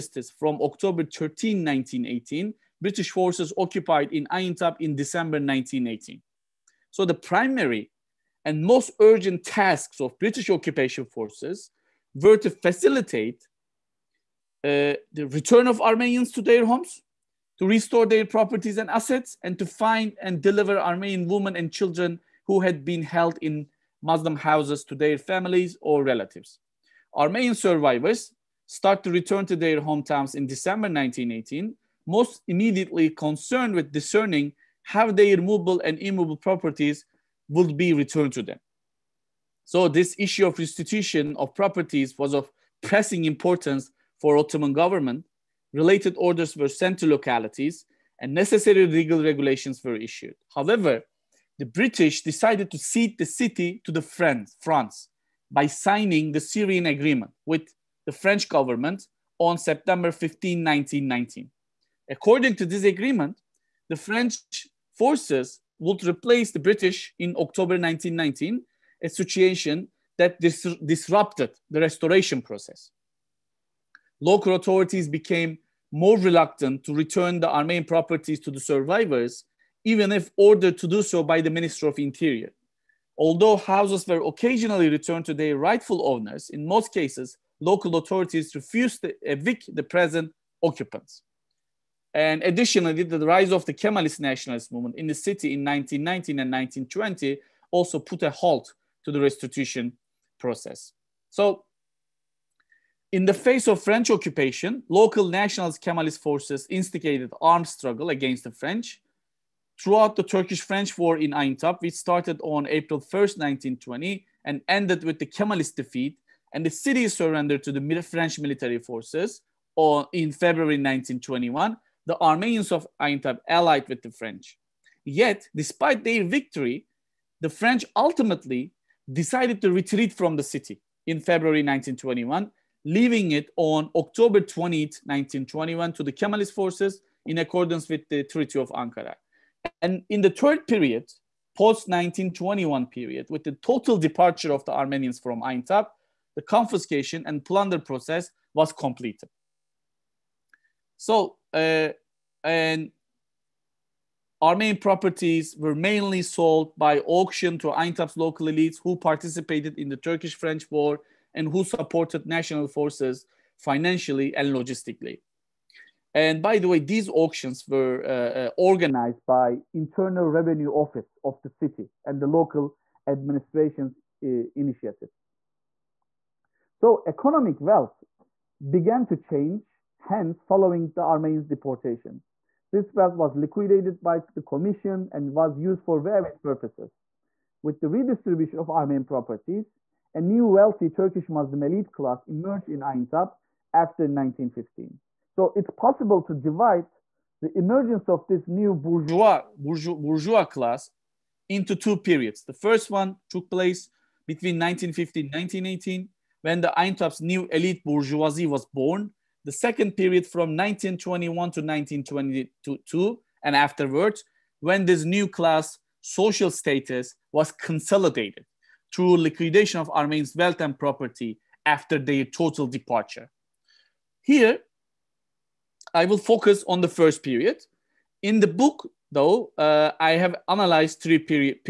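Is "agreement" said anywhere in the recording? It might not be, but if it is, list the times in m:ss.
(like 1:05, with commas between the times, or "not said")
0:56, 1:02.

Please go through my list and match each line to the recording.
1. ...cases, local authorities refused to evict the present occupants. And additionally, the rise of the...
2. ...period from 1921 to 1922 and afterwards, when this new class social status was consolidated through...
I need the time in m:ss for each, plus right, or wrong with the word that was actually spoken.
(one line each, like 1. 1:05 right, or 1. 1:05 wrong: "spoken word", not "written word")
1. 1:26 right
2. 3:29 right.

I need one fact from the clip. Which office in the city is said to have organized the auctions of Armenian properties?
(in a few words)
Internal Revenue Office.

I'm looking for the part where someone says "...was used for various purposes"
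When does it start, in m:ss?
3:05.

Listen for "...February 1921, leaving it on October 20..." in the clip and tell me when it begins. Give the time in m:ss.
2:11.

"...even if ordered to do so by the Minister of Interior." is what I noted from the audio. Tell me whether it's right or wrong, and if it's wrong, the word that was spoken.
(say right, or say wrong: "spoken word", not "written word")
right.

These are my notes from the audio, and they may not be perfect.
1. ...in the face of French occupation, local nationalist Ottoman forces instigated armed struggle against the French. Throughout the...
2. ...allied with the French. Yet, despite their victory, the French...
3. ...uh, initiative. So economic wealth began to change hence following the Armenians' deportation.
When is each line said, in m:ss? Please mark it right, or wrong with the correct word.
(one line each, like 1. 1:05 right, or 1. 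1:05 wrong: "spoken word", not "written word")
1. 1:43 wrong: "Kemalist", not "Ottoman"
2. 2:03 right
3. 2:54 right.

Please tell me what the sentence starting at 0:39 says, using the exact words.
So this issue of restitution of properties was of pressing importance for Ottoman government.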